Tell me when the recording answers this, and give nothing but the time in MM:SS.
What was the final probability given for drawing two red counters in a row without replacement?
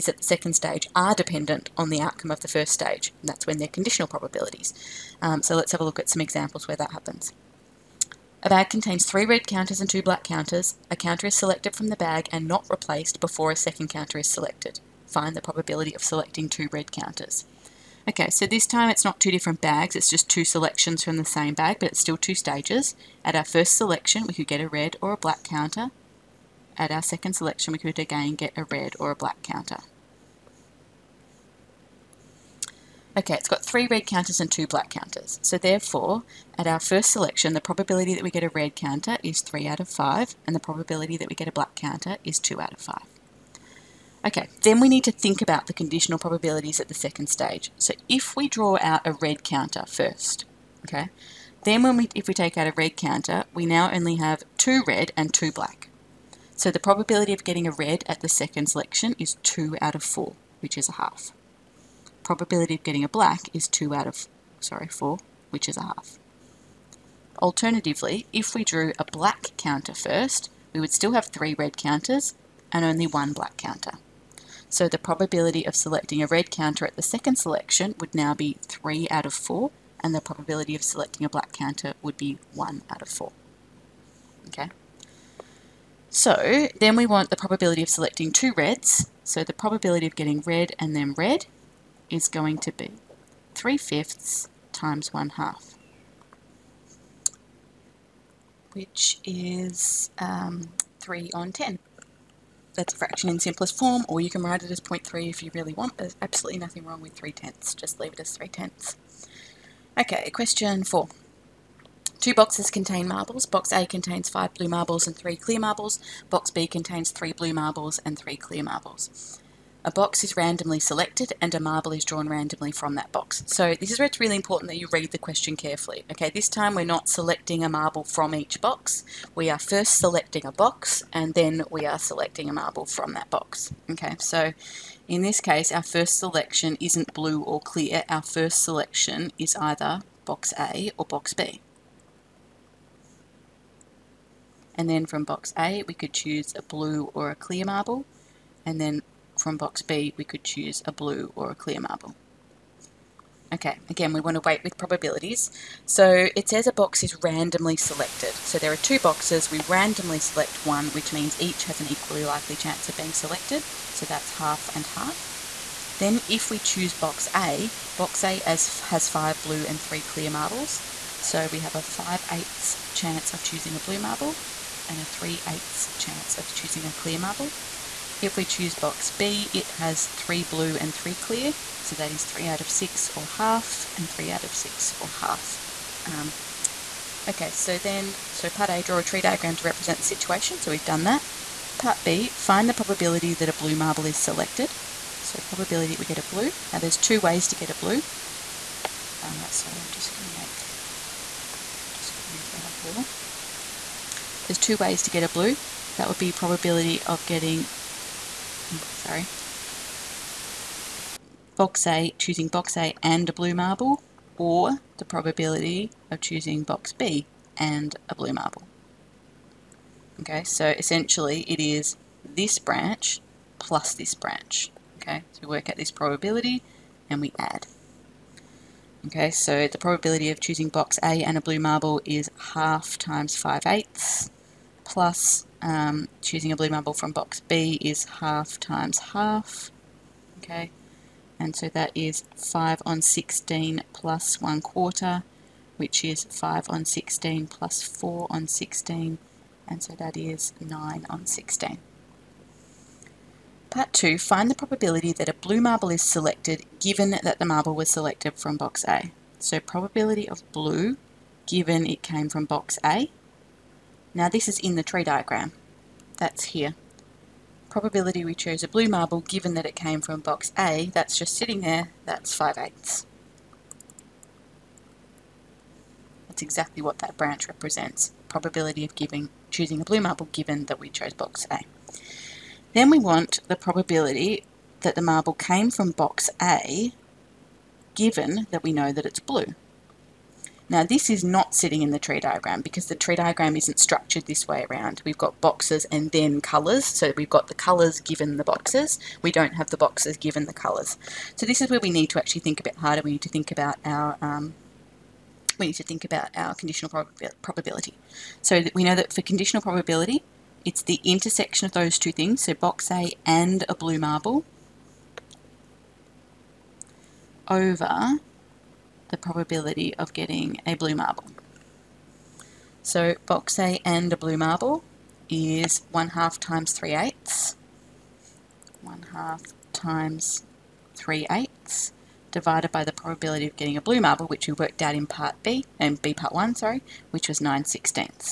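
01:41.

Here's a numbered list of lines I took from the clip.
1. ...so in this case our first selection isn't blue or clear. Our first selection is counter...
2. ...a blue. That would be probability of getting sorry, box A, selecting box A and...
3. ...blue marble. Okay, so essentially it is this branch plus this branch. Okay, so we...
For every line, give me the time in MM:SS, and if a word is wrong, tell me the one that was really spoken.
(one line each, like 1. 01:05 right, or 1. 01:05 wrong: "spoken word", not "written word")
1. 02:14 wrong: "either", not "counter"
2. 03:25 wrong: "choosing", not "selecting"
3. 03:38 right.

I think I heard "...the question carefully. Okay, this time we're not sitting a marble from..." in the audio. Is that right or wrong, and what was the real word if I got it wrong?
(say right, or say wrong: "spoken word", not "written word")
wrong: "selecting", not "sitting".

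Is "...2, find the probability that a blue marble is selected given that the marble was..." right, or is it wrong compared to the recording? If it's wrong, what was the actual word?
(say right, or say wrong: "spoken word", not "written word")
right.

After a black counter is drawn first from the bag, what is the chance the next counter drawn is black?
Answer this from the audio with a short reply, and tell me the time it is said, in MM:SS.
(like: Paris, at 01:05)
1/4, at 01:22.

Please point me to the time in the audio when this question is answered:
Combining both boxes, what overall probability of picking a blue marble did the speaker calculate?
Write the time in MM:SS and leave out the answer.
04:10.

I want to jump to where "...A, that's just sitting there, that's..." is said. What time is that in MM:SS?
04:30.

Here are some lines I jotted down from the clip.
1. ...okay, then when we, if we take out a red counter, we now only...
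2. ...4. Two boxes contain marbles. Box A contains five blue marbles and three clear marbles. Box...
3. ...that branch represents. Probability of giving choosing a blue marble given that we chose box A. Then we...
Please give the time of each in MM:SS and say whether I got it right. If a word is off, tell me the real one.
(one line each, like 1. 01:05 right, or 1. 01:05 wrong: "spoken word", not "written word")
1. 00:50 right
2. 01:50 right
3. 04:36 right.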